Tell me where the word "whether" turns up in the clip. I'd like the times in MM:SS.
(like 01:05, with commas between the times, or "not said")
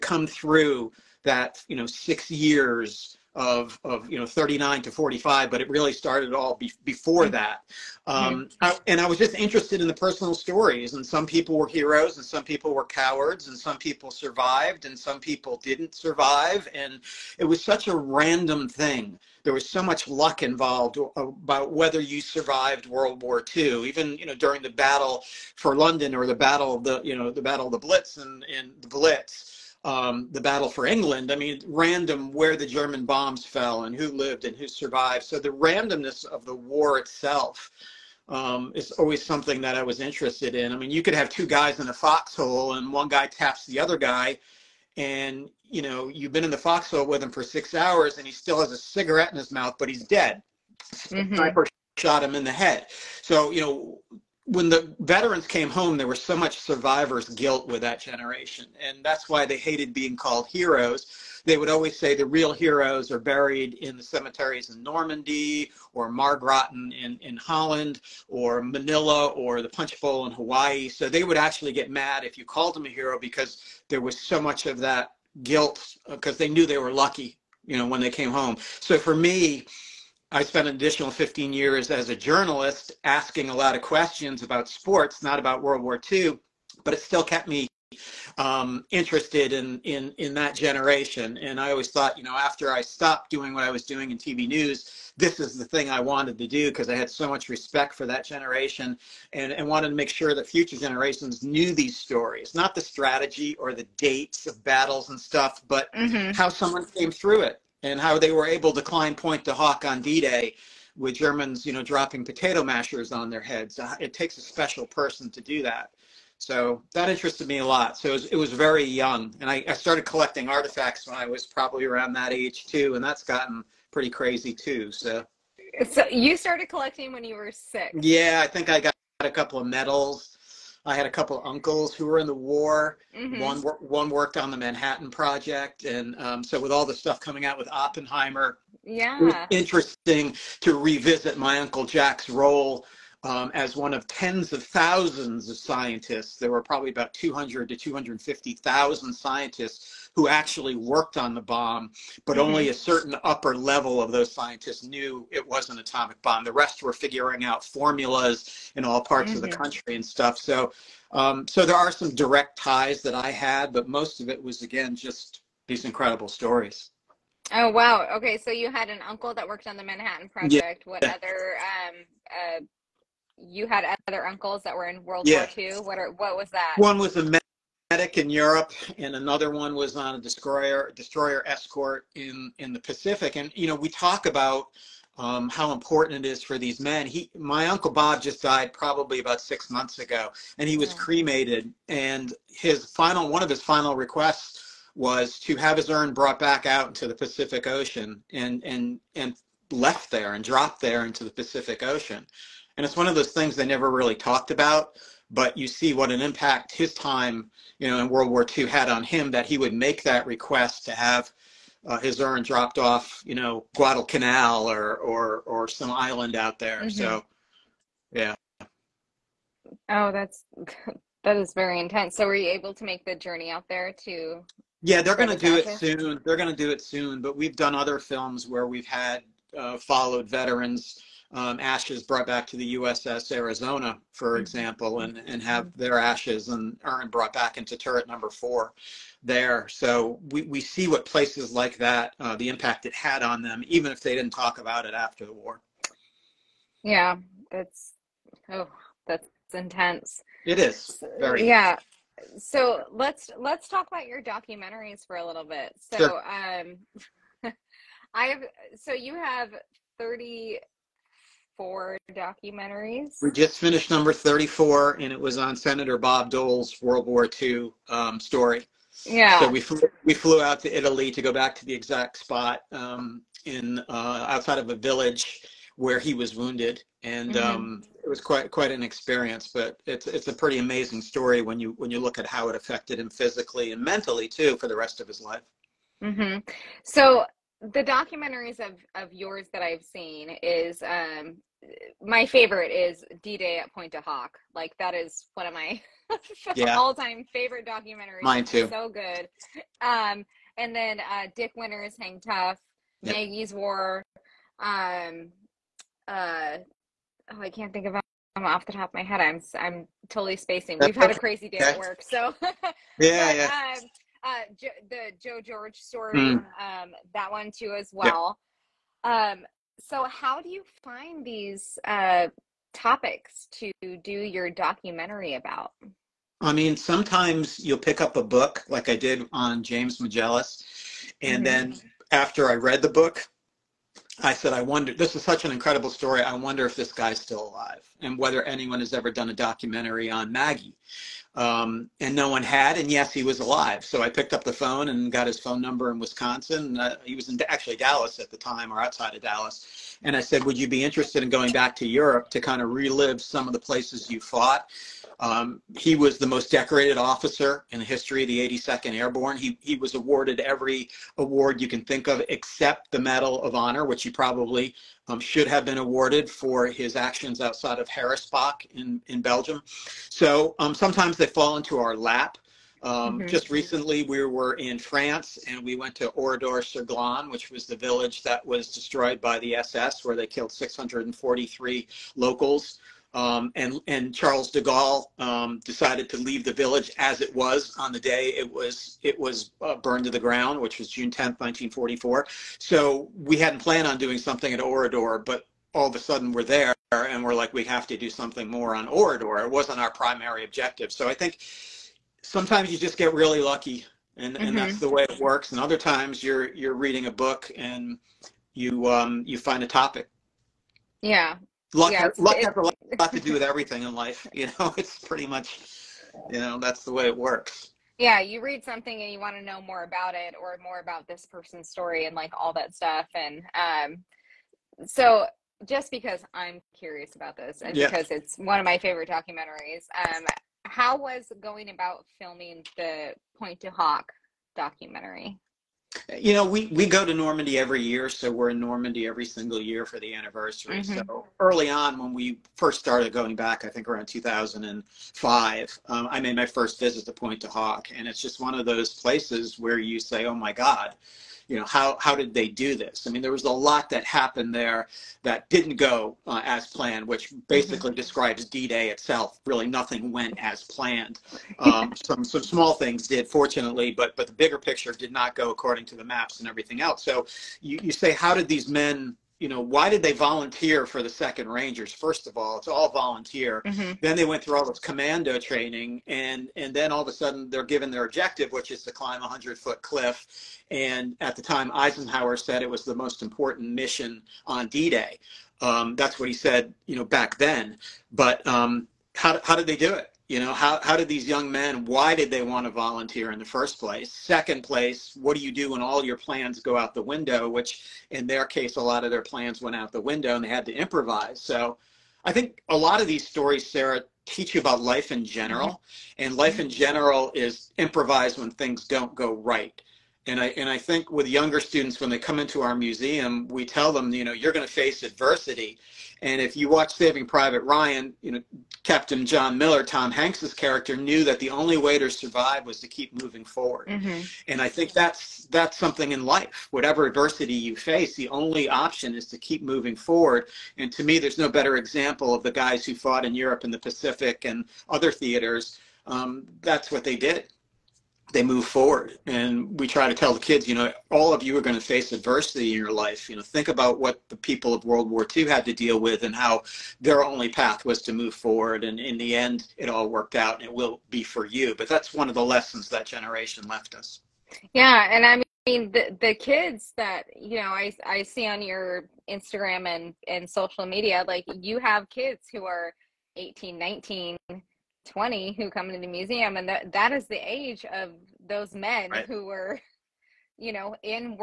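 00:21, 05:38.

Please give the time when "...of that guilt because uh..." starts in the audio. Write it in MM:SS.
01:14.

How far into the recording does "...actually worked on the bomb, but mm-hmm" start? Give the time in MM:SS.
02:30.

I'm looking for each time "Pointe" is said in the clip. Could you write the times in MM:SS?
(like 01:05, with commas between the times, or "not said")
01:49, 04:53, 07:13, 07:27.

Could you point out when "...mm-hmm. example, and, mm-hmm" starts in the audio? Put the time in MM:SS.
03:54.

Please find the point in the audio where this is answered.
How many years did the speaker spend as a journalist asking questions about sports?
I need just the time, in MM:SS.
01:21.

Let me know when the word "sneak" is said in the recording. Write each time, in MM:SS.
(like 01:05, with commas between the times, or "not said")
not said.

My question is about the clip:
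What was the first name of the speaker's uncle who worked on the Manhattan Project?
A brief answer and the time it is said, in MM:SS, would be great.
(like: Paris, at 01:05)
Jack, at 02:21.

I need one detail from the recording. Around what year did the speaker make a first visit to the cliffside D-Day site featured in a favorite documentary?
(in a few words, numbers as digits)
2005.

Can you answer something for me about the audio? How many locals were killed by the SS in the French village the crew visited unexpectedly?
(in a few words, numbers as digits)
643.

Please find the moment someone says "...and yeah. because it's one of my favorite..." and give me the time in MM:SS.
07:07.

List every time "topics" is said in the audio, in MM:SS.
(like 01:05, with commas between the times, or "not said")
05:22, 06:49.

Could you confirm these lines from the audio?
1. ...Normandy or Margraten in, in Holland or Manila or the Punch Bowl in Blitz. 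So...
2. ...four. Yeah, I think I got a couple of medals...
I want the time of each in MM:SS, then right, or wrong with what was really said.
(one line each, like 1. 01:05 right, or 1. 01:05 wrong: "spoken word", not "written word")
1. 01:04 wrong: "Hawaii", not "Blitz"
2. 02:07 wrong: "six", not "four".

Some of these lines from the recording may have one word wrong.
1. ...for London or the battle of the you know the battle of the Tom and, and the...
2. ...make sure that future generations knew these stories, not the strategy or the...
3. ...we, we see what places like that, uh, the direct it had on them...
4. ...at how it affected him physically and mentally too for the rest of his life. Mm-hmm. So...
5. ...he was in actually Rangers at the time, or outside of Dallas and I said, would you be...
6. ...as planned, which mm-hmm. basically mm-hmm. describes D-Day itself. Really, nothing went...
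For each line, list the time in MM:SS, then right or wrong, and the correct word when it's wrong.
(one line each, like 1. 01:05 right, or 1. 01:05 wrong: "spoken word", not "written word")
1. 00:25 wrong: "Blitz", not "Tom"
2. 01:39 right
3. 04:00 wrong: "impact", not "direct"
4. 04:42 right
5. 05:47 wrong: "Dallas", not "Rangers"
6. 07:36 right.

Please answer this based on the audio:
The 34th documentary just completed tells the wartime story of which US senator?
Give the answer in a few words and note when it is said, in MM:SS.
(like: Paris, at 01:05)
Bob Dole, at 04:25.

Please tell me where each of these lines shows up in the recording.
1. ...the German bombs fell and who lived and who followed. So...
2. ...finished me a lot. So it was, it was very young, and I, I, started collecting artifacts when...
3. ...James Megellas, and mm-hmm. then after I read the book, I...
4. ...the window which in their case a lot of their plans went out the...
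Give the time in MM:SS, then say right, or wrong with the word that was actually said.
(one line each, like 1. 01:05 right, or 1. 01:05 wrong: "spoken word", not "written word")
1. 00:32 wrong: "survived", not "followed"
2. 01:57 wrong: "interested", not "finished"
3. 05:29 right
4. 08:16 right.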